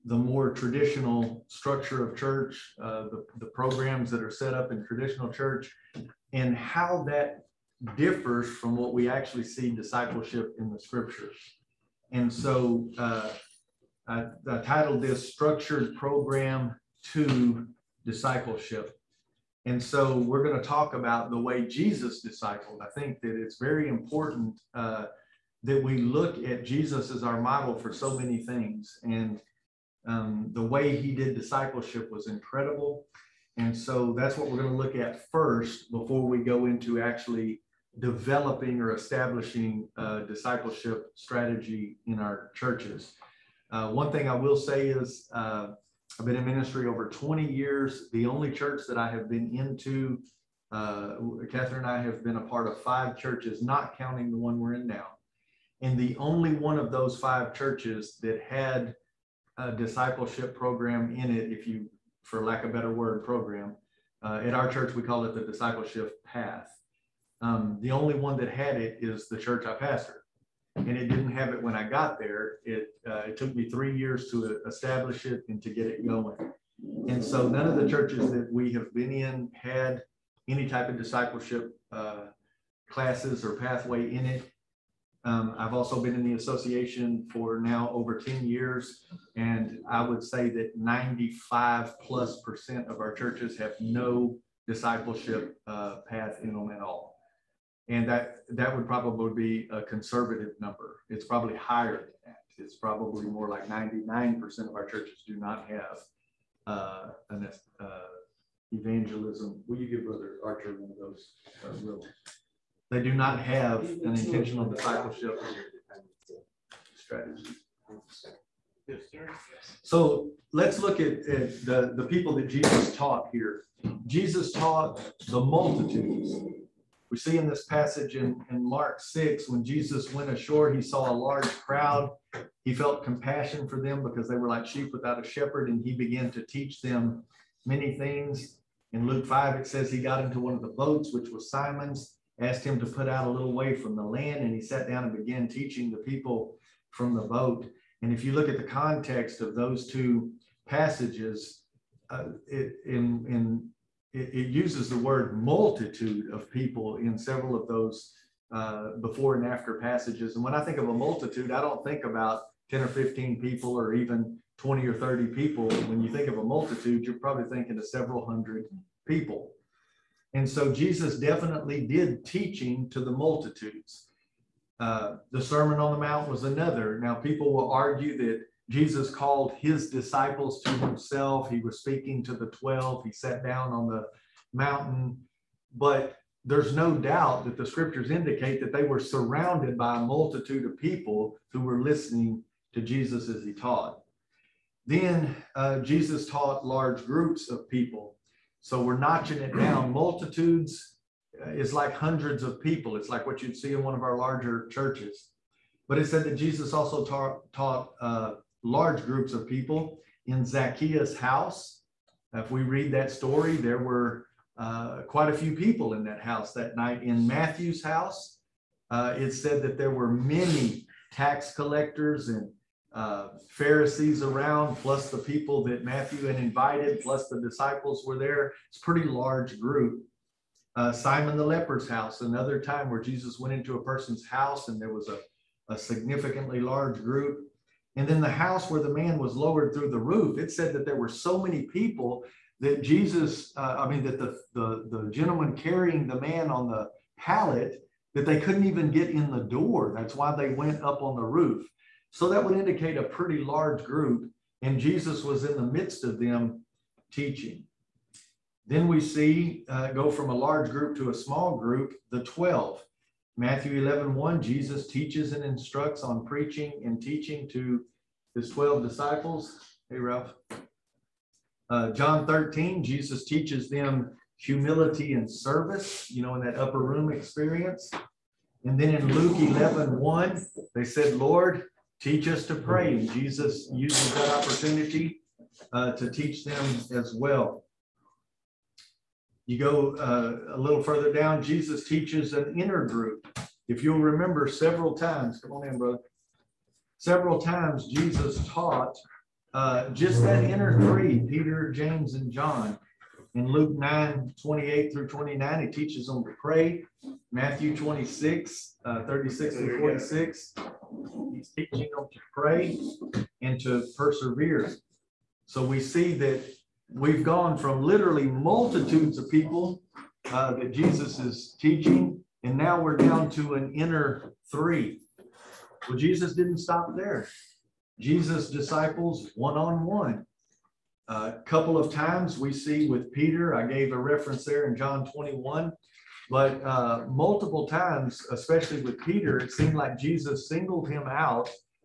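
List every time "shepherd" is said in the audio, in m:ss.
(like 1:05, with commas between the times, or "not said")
2:15.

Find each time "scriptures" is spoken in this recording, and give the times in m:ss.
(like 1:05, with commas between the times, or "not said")
0:10, 3:07.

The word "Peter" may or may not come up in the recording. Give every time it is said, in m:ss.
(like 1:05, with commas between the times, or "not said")
5:01, 5:33, 5:38.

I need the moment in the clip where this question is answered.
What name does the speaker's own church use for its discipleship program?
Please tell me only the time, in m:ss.
1:05.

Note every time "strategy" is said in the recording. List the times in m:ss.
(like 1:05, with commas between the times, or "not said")
0:41, 1:56.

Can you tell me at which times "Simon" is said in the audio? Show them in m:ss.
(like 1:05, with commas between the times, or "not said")
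2:21, 3:50.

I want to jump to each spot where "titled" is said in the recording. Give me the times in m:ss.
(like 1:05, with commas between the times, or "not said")
0:14.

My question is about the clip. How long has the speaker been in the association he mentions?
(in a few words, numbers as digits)
over 10 years.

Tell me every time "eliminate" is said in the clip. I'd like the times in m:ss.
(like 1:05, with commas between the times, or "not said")
not said.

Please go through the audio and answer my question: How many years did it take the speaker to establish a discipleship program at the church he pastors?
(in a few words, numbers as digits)
3.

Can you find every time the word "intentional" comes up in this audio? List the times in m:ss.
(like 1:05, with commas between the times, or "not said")
1:54.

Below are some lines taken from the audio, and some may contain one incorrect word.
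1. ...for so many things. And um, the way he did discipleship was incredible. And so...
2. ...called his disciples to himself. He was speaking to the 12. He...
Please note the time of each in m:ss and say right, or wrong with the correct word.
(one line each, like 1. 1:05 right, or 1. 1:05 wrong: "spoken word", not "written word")
1. 0:27 right
2. 2:59 right.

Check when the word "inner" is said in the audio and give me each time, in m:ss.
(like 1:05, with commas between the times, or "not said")
4:52, 5:00, 5:23.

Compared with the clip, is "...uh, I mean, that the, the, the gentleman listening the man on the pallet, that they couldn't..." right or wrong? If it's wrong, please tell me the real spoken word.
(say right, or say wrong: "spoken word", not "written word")
wrong: "carrying", not "listening".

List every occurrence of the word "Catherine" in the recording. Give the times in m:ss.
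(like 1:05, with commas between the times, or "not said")
0:51.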